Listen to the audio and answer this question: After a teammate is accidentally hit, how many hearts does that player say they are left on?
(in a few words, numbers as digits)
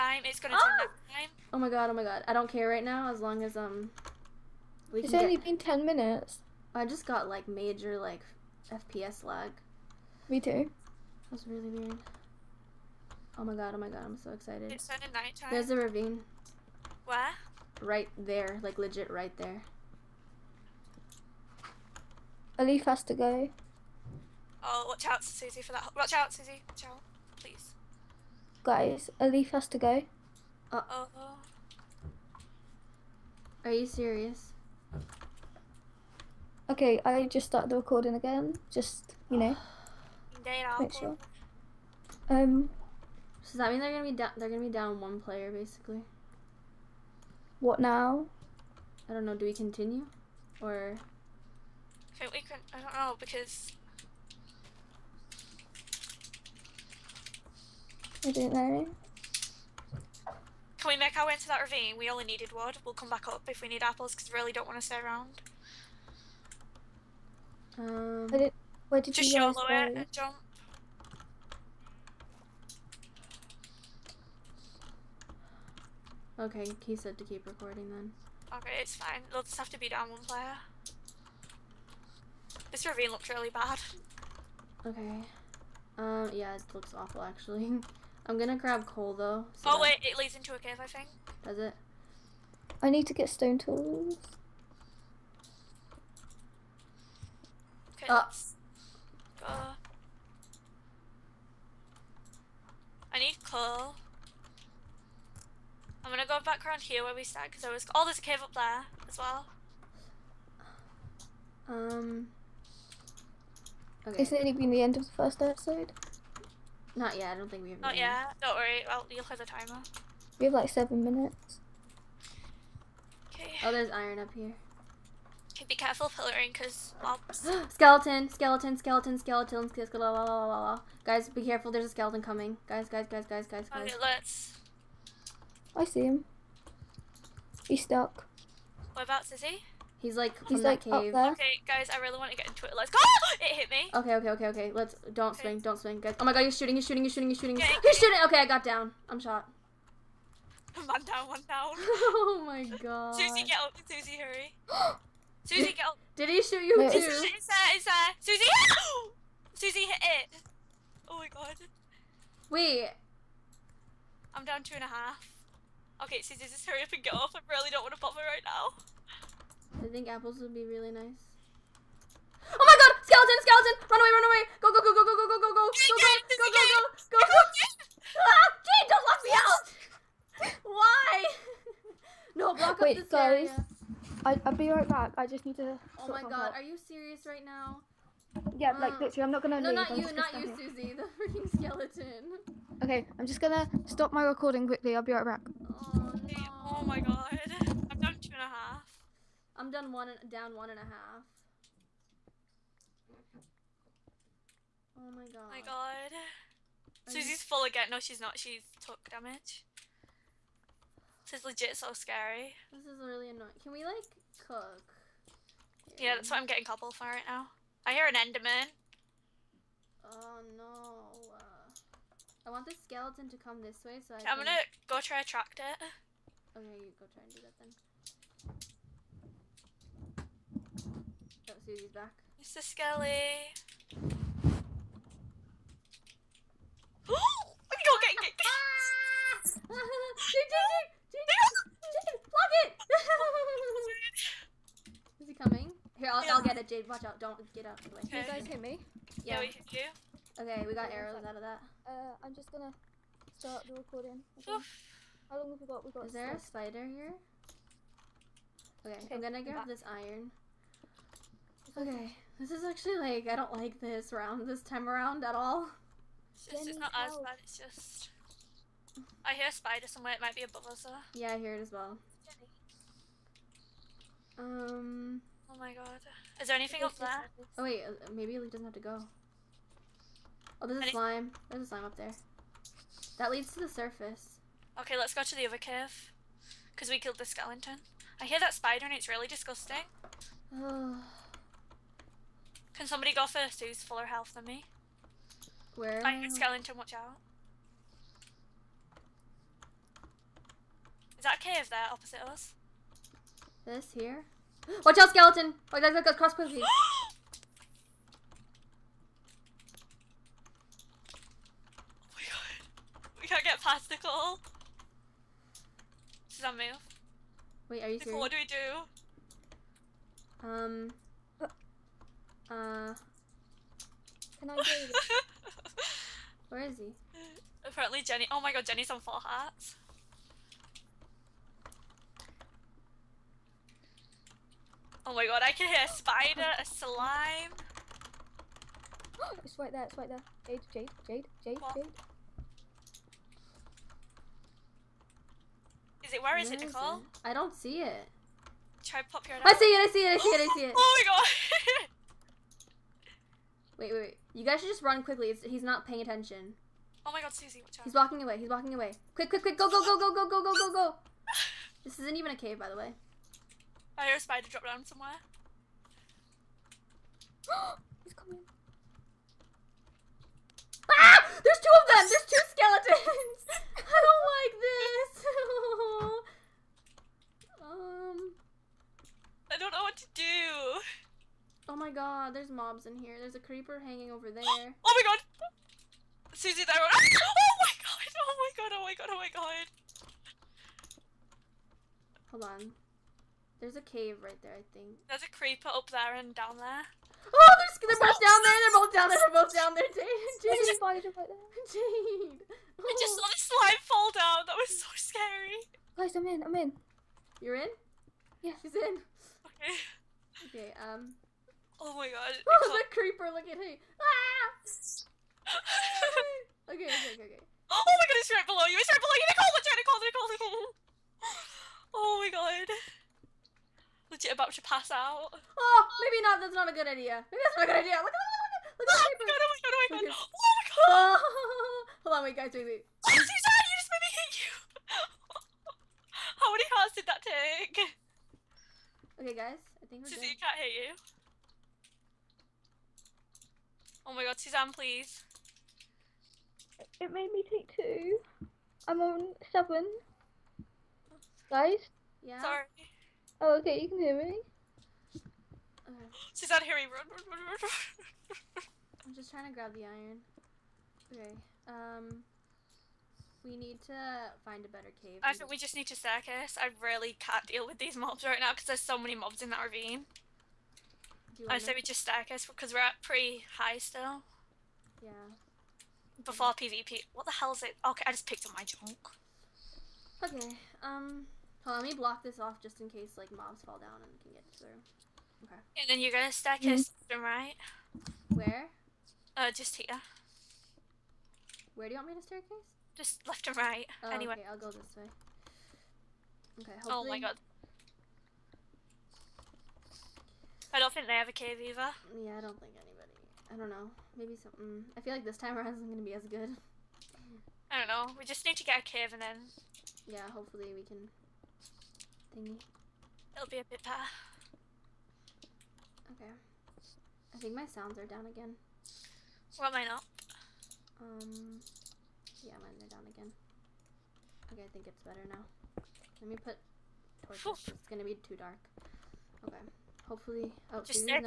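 7.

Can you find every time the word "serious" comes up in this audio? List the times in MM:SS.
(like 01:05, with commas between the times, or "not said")
00:33, 05:18.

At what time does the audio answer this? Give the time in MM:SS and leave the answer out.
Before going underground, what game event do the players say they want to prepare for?
07:56.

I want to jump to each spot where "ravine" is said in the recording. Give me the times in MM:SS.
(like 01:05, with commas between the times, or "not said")
00:15, 01:01, 01:22, 07:49.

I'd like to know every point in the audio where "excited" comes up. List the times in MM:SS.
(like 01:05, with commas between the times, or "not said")
00:14.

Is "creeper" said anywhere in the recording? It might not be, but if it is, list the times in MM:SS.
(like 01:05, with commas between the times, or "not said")
06:23, 06:35, 06:52.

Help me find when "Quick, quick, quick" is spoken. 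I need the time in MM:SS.
05:59.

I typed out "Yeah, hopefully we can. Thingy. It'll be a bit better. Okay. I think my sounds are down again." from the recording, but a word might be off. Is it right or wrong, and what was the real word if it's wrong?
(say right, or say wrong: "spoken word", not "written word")
right.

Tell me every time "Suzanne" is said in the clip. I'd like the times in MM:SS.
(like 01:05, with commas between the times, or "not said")
07:13, 07:24, 07:36.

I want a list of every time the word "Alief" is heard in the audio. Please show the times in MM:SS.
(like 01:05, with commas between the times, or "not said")
00:22, 00:29.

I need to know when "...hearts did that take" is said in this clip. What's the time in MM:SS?
07:16.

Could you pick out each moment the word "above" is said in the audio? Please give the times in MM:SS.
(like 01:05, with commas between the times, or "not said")
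04:30.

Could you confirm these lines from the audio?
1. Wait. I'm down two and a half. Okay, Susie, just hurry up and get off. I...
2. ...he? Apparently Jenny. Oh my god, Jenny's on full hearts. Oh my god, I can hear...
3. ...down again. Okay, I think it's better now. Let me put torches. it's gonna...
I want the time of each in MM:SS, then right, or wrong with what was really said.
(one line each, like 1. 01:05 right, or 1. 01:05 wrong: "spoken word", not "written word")
1. 02:42 right
2. 05:26 right
3. 08:42 right.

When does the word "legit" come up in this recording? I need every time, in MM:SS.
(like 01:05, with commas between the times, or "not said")
00:18, 03:31, 07:04.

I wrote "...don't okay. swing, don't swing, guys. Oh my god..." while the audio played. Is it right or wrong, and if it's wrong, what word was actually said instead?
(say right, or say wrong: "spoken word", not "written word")
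right.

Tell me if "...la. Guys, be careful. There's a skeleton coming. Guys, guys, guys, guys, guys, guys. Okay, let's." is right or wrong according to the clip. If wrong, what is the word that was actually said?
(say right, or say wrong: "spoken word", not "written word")
right.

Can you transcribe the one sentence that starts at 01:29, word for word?
So oh wait, it leads into a cave, I think.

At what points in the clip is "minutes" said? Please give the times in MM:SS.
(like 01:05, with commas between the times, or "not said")
00:05, 02:01.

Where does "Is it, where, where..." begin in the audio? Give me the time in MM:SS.
05:46.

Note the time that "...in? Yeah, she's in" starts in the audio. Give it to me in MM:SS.
06:47.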